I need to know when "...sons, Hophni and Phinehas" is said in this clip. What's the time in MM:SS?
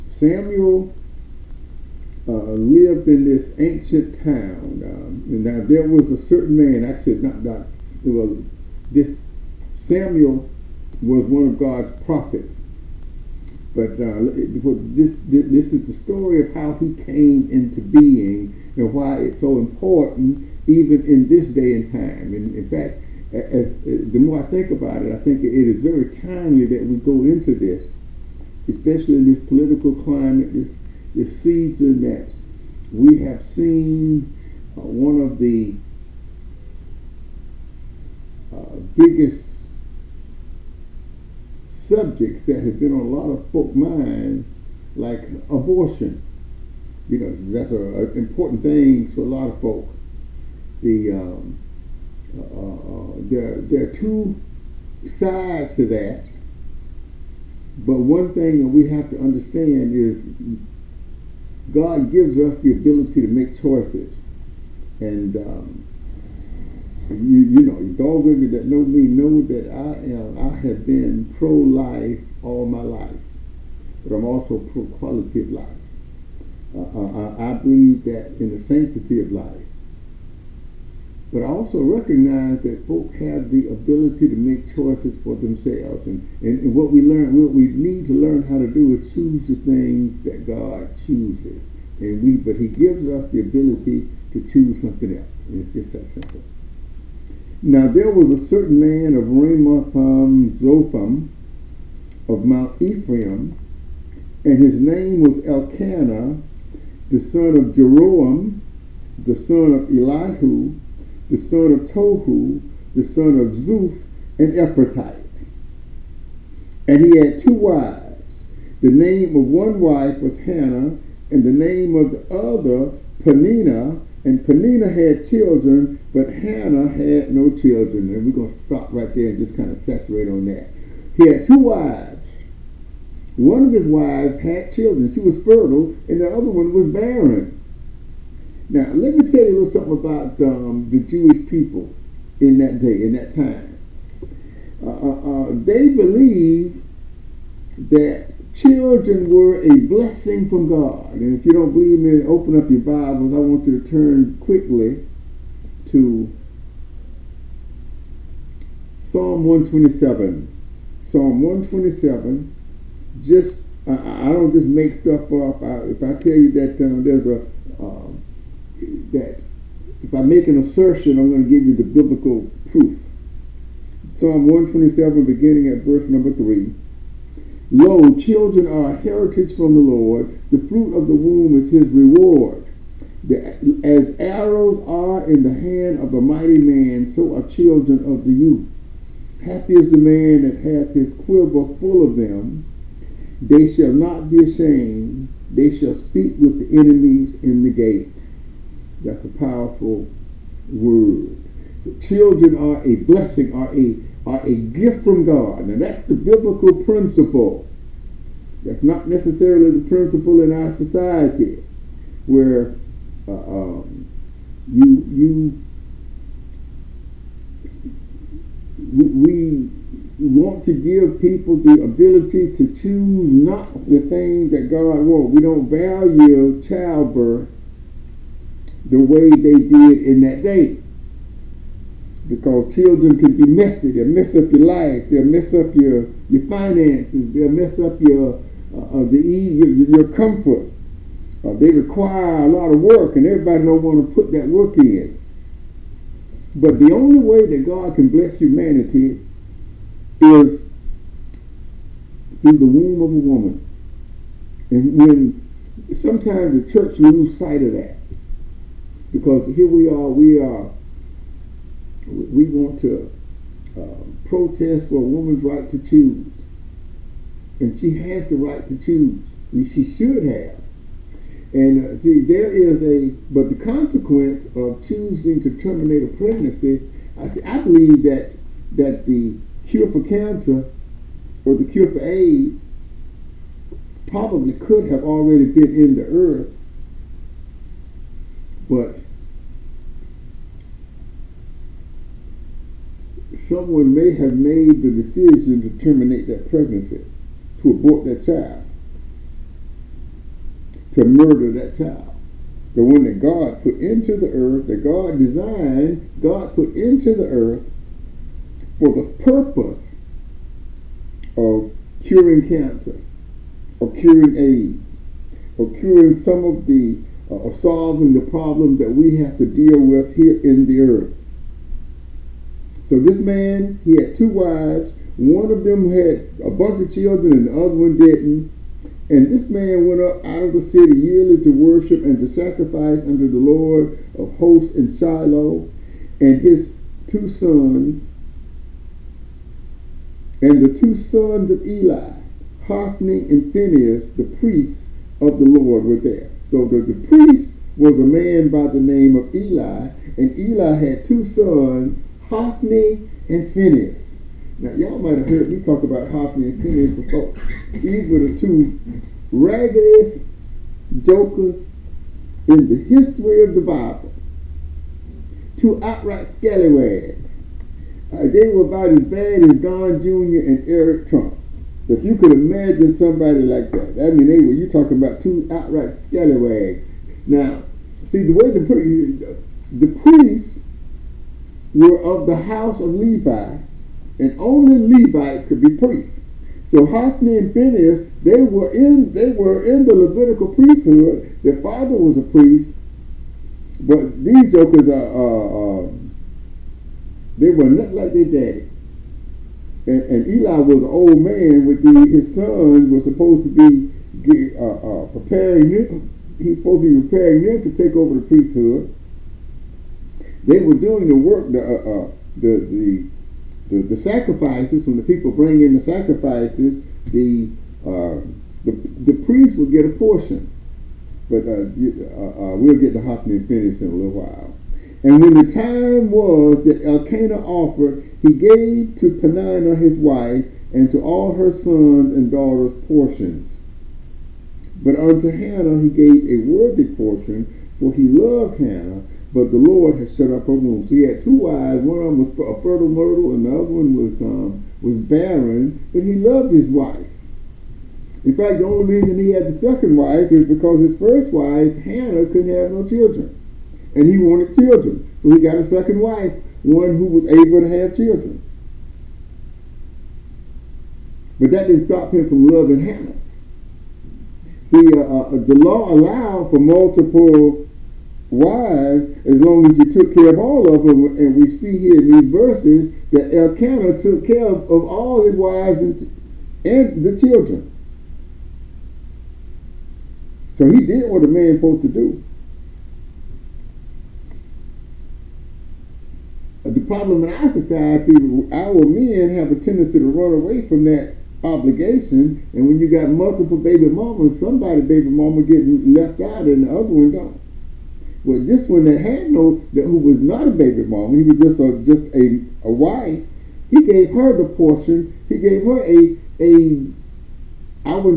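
05:51.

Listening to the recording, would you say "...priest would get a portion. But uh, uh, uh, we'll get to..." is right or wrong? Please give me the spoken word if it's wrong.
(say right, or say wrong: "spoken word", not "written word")
right.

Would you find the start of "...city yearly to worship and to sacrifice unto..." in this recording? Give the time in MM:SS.
05:30.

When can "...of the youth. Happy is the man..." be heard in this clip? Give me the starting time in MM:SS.
03:07.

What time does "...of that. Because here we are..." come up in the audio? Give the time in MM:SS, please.
04:17.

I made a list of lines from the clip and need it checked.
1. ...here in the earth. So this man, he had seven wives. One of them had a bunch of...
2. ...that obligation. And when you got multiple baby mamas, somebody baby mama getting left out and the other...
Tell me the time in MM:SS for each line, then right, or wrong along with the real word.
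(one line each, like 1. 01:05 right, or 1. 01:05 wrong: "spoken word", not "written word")
1. 05:20 wrong: "two", not "seven"
2. 08:10 right.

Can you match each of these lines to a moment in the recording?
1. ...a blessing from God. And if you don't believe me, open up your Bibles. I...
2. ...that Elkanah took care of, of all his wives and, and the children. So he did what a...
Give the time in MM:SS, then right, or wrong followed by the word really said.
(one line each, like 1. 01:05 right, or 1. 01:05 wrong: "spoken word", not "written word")
1. 02:29 right
2. 07:53 right.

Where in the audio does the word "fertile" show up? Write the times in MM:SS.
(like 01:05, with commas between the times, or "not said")
02:15, 07:22.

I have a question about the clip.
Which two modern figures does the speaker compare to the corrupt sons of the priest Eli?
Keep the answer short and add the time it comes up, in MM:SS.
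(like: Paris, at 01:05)
Don Jr. and Eric Trump, at 06:09.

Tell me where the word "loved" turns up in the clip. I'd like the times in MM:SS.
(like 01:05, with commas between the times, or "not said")
07:18, 07:26.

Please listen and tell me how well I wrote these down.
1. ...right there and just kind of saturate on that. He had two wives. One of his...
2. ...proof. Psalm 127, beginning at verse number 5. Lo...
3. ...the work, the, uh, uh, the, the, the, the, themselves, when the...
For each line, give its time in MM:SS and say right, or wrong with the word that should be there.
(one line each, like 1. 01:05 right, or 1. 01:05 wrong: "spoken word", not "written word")
1. 02:08 right
2. 02:52 wrong: "3", not "5"
3. 06:51 wrong: "sacrifices", not "themselves".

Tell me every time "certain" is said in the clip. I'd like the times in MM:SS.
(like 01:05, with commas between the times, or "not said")
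00:06, 01:38.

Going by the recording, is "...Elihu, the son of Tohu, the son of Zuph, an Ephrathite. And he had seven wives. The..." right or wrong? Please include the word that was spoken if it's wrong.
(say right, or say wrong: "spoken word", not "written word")
wrong: "two", not "seven".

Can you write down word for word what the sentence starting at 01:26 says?
And, and, and, what we learn, what we need to learn how to do is choose the things that God chooses.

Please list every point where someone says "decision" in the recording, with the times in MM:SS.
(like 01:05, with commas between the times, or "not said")
04:54.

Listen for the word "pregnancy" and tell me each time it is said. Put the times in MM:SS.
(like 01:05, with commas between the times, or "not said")
04:36, 04:56.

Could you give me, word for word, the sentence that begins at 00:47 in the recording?
You know, that's an important thing to a lot of folk the um, uh, uh, there, there are two sides to that.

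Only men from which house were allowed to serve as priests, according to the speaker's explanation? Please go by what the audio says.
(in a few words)
House of Levi.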